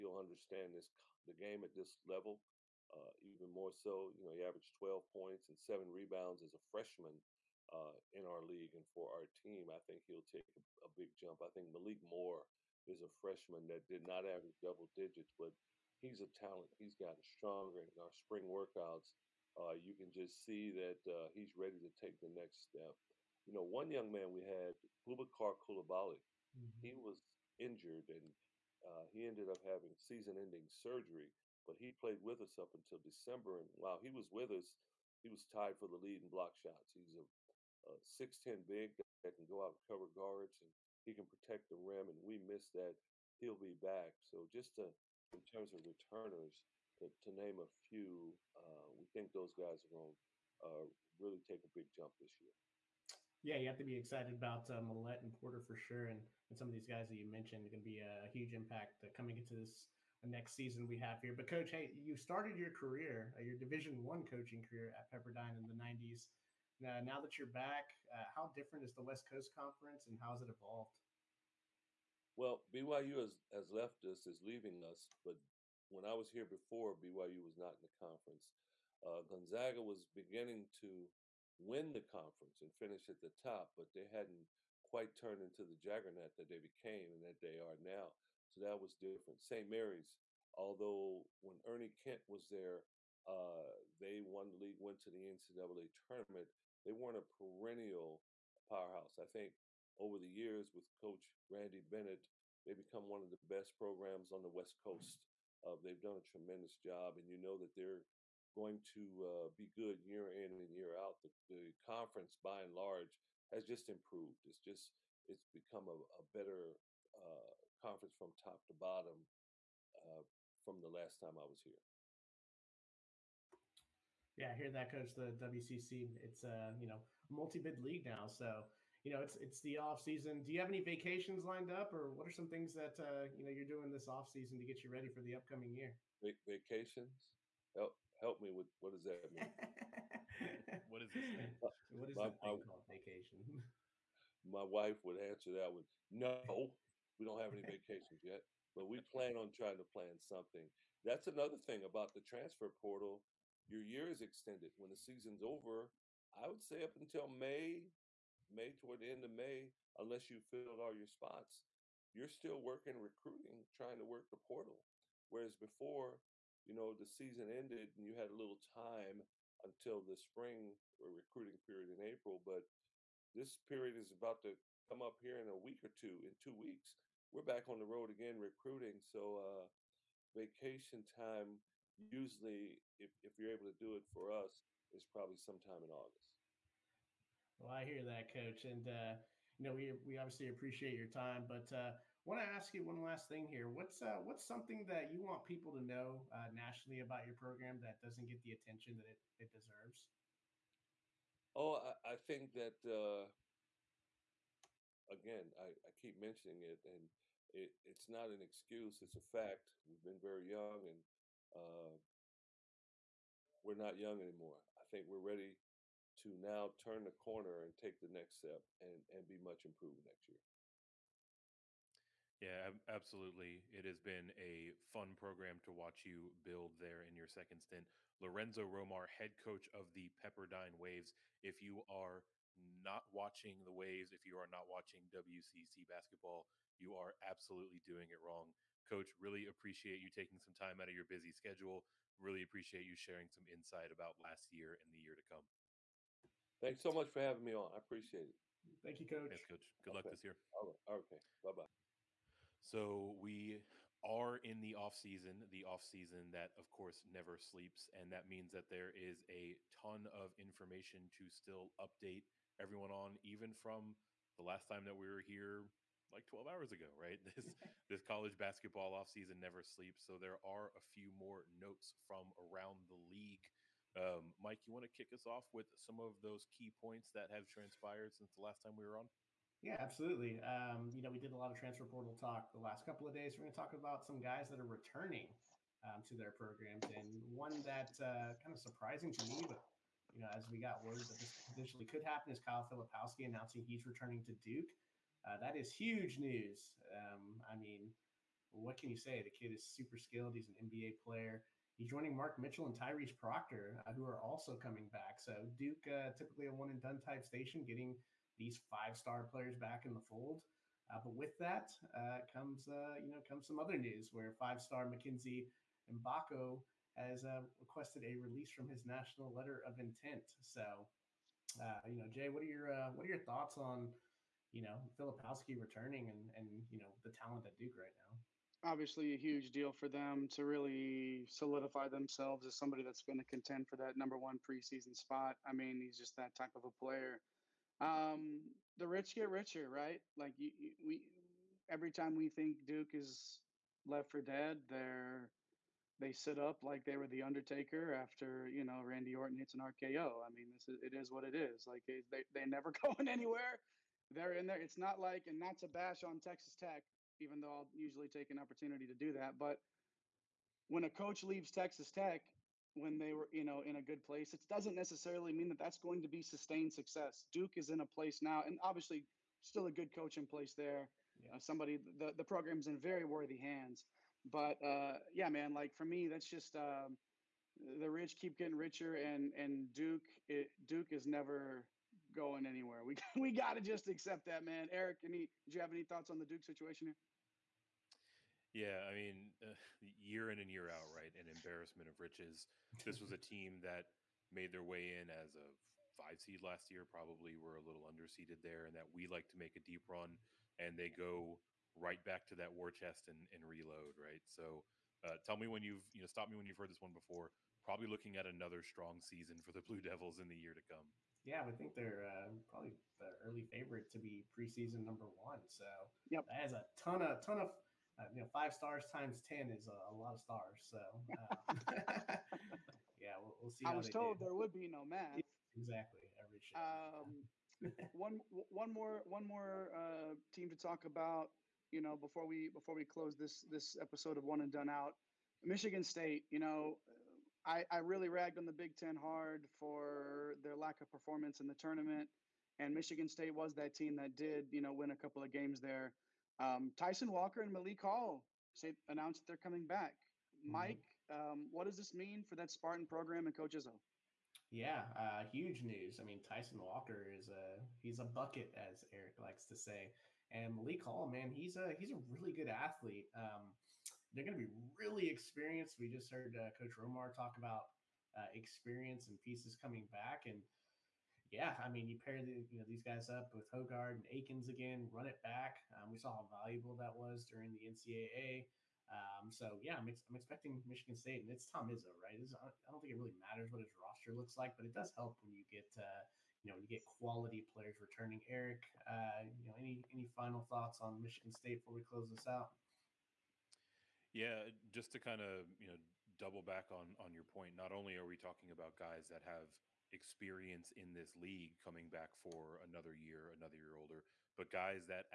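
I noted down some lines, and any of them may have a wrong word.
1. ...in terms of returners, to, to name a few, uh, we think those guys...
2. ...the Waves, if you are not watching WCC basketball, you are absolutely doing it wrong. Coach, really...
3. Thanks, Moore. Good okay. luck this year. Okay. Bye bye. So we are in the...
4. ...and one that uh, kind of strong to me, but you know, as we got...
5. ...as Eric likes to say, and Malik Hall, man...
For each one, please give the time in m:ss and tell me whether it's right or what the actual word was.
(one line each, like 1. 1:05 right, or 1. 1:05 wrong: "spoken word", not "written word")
1. 0:45 right
2. 3:53 right
3. 4:09 wrong: "Coach", not "Moore"
4. 4:46 wrong: "surprising", not "strong"
5. 7:38 right.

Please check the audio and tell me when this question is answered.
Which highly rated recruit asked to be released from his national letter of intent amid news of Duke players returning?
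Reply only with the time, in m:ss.
5:14.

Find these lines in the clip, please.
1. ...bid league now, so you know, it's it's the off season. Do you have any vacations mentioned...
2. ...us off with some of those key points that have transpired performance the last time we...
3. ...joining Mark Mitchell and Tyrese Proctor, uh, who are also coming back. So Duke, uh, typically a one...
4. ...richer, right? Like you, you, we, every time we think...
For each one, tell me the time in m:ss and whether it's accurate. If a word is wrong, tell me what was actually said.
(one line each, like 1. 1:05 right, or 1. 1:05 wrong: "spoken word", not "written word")
1. 2:07 wrong: "lined", not "mentioned"
2. 4:35 wrong: "since", not "performance"
3. 5:01 right
4. 5:39 right.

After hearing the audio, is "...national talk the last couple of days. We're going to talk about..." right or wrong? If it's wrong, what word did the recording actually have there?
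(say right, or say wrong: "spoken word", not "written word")
wrong: "portal", not "national".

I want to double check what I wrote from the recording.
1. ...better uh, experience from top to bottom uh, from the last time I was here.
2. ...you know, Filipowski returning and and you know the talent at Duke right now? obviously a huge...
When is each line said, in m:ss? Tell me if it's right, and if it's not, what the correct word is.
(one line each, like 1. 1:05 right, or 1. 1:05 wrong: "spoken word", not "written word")
1. 1:56 wrong: "conference", not "experience"
2. 5:24 right.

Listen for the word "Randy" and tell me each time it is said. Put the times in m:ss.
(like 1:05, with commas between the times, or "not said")
1:41, 5:48.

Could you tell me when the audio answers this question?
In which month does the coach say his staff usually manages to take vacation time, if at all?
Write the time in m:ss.
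3:05.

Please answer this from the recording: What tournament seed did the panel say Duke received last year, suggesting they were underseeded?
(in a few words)
5.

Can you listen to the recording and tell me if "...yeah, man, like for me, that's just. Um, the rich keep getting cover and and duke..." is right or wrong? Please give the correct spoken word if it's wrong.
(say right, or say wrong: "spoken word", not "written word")
wrong: "richer", not "cover".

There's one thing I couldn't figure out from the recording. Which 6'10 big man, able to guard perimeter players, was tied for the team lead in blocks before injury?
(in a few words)
Boubacar Coulibaly.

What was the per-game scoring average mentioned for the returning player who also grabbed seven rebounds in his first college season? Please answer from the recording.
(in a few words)
12.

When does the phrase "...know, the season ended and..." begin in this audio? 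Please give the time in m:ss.
2:46.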